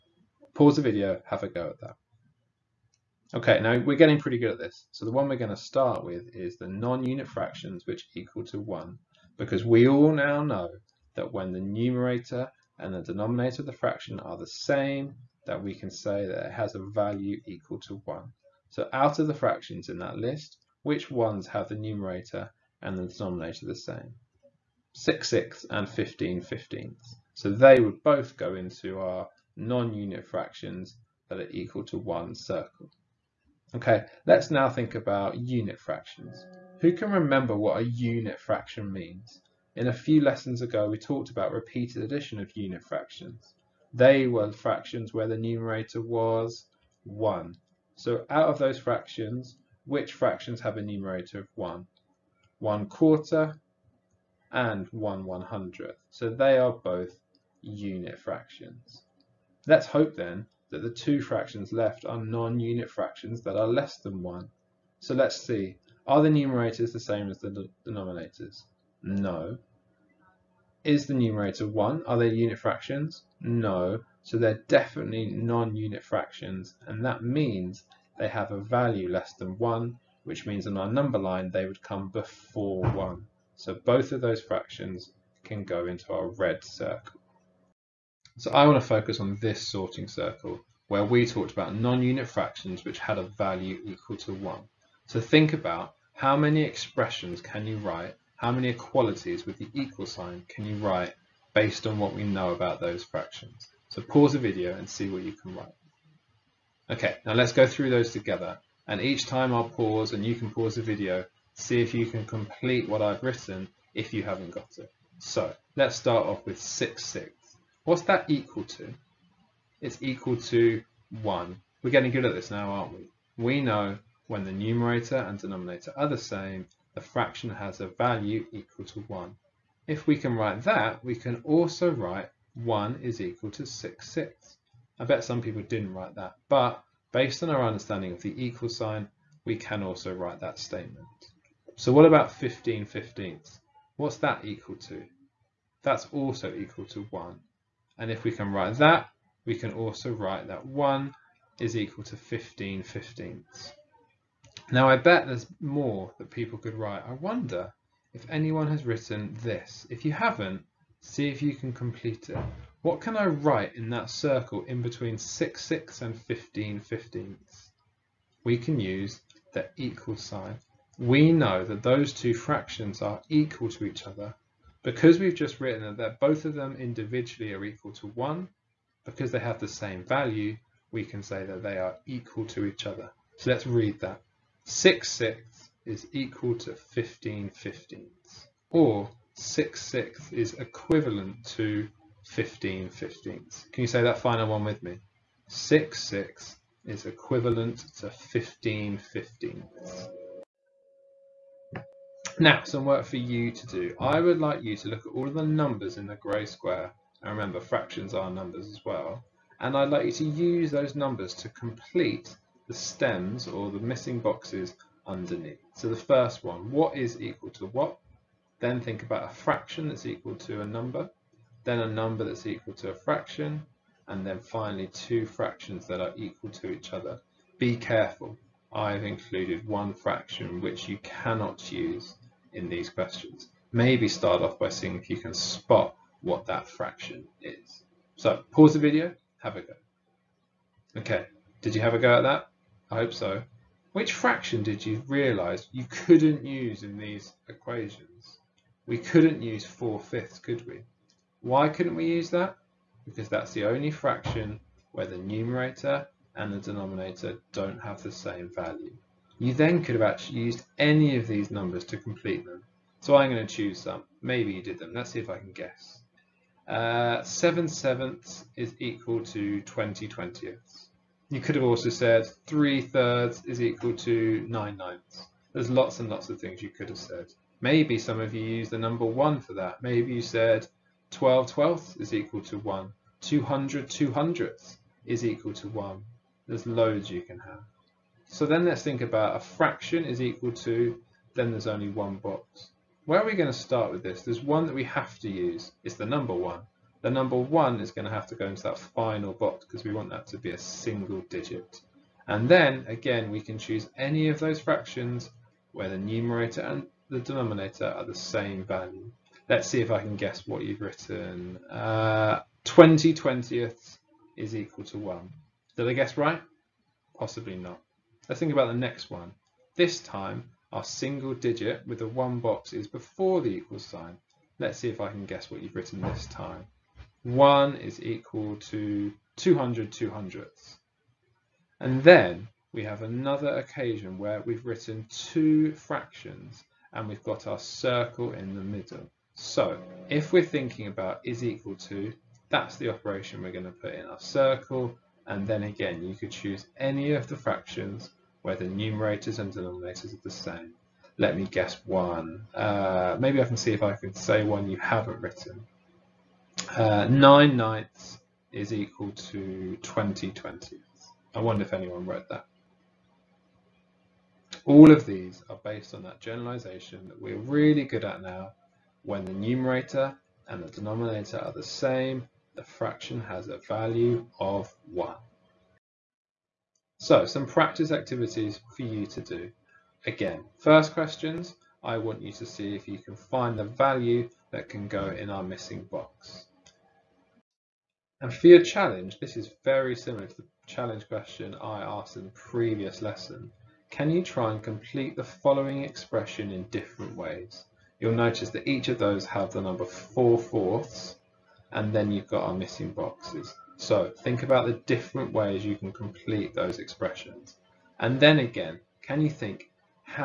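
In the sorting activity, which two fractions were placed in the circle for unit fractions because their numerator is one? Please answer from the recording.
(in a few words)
1 quarter and 1 one hundredth.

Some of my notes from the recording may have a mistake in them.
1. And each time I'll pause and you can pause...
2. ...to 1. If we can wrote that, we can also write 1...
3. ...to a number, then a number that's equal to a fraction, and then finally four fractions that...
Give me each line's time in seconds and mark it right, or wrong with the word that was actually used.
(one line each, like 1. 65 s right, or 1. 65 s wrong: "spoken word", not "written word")
1. 108 s right
2. 128 s wrong: "write", not "wrote"
3. 220 s wrong: "two", not "four".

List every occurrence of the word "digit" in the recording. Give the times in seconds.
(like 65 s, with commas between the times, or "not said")
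301 s, 321 s.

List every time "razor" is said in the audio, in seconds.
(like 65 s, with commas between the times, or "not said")
not said.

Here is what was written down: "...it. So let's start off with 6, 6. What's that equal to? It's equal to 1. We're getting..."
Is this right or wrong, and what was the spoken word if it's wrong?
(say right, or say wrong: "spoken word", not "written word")
right.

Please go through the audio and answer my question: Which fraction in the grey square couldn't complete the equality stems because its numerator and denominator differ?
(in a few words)
4 fifths.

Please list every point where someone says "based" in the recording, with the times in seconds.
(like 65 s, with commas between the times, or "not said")
101 s, 137 s, 365 s.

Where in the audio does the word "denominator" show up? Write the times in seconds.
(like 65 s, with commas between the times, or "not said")
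13 s, 23 s, 67 s, 125 s, 256 s, 307 s, 349 s, 370 s.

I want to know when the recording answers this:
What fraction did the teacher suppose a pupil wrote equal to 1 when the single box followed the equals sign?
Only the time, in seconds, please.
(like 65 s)
312 s.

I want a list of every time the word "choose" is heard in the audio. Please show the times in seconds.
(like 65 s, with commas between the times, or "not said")
263 s, 303 s, 346 s.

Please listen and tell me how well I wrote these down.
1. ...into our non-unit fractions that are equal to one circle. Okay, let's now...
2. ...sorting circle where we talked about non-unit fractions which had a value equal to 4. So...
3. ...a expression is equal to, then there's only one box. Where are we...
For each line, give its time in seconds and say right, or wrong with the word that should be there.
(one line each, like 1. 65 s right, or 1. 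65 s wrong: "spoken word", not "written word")
1. 28 s right
2. 89 s wrong: "1", not "4"
3. 289 s wrong: "fraction", not "expression".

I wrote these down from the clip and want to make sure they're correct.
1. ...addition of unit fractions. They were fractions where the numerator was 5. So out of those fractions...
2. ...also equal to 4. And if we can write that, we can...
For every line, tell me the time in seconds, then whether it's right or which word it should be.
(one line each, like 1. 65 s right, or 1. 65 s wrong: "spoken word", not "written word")
1. 42 s wrong: "1", not "5"
2. 146 s wrong: "1", not "4".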